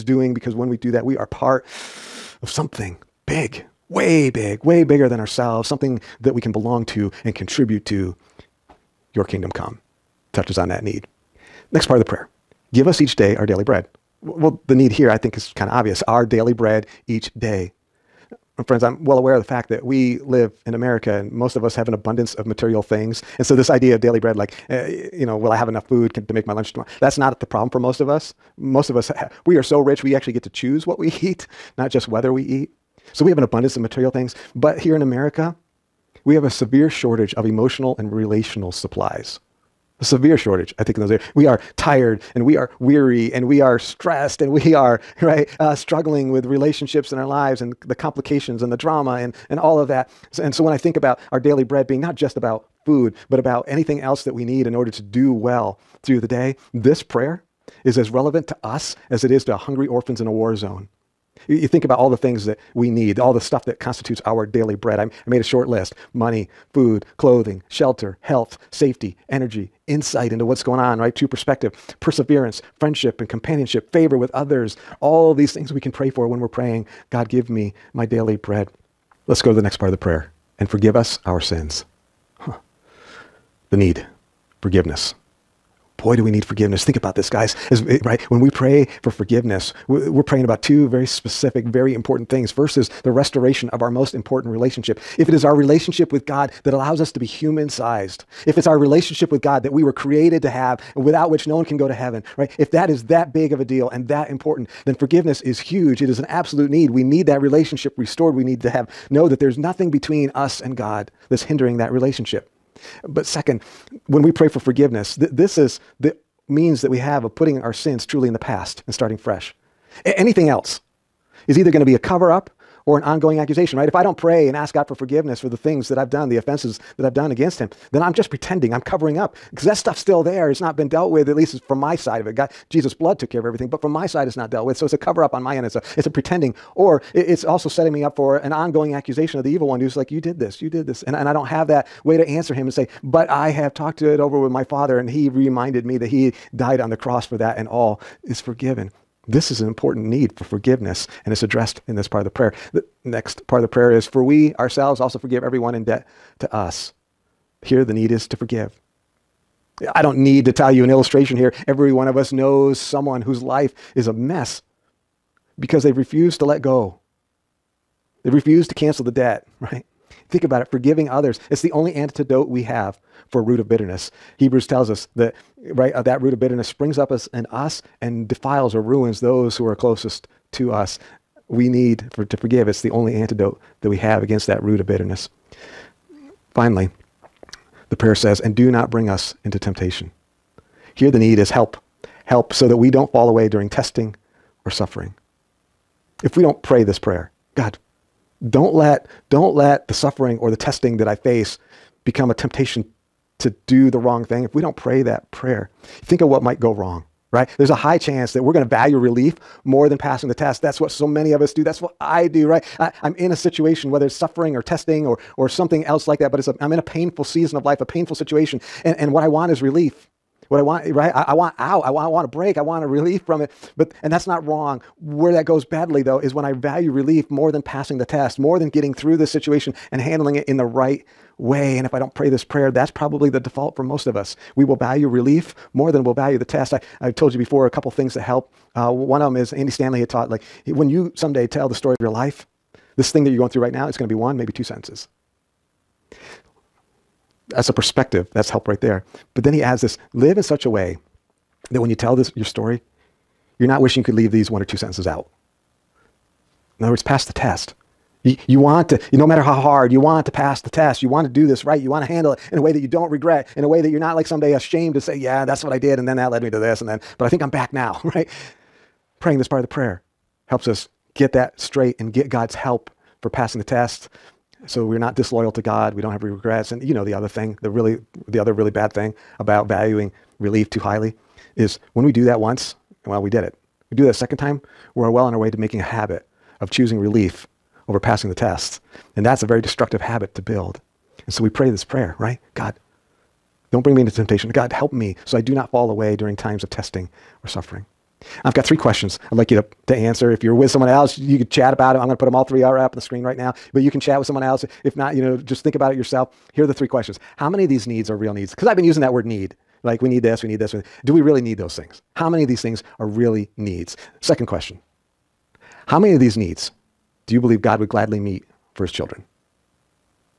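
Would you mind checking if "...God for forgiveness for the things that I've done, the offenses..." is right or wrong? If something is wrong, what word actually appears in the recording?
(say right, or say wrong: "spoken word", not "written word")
right.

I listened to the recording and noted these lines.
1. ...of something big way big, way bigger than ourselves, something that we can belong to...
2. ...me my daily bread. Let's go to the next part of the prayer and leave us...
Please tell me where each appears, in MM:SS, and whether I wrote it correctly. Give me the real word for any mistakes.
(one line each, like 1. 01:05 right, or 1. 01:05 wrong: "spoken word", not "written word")
1. 00:02 right
2. 01:17 wrong: "forgive", not "leave".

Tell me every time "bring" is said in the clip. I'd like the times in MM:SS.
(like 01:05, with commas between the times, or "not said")
03:08, 04:53.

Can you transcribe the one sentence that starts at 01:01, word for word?
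You think about all the things that we need, all the stuff that constitutes our daily bread.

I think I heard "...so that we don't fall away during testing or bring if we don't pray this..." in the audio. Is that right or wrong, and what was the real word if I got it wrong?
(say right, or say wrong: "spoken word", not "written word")
wrong: "suffering", not "bring".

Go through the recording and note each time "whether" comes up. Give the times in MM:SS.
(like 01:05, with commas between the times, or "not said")
00:32, 03:33.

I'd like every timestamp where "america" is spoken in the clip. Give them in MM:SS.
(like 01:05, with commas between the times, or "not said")
00:20, 00:35.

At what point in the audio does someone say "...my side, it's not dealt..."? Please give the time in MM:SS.
02:13.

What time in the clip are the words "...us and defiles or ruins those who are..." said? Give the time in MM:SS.
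02:57.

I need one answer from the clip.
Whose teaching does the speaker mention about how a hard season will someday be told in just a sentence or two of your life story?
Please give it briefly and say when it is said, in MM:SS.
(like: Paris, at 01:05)
Andy Stanley, at 03:59.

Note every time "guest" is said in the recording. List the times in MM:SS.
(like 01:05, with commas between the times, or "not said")
not said.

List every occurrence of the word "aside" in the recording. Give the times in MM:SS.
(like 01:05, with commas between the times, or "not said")
not said.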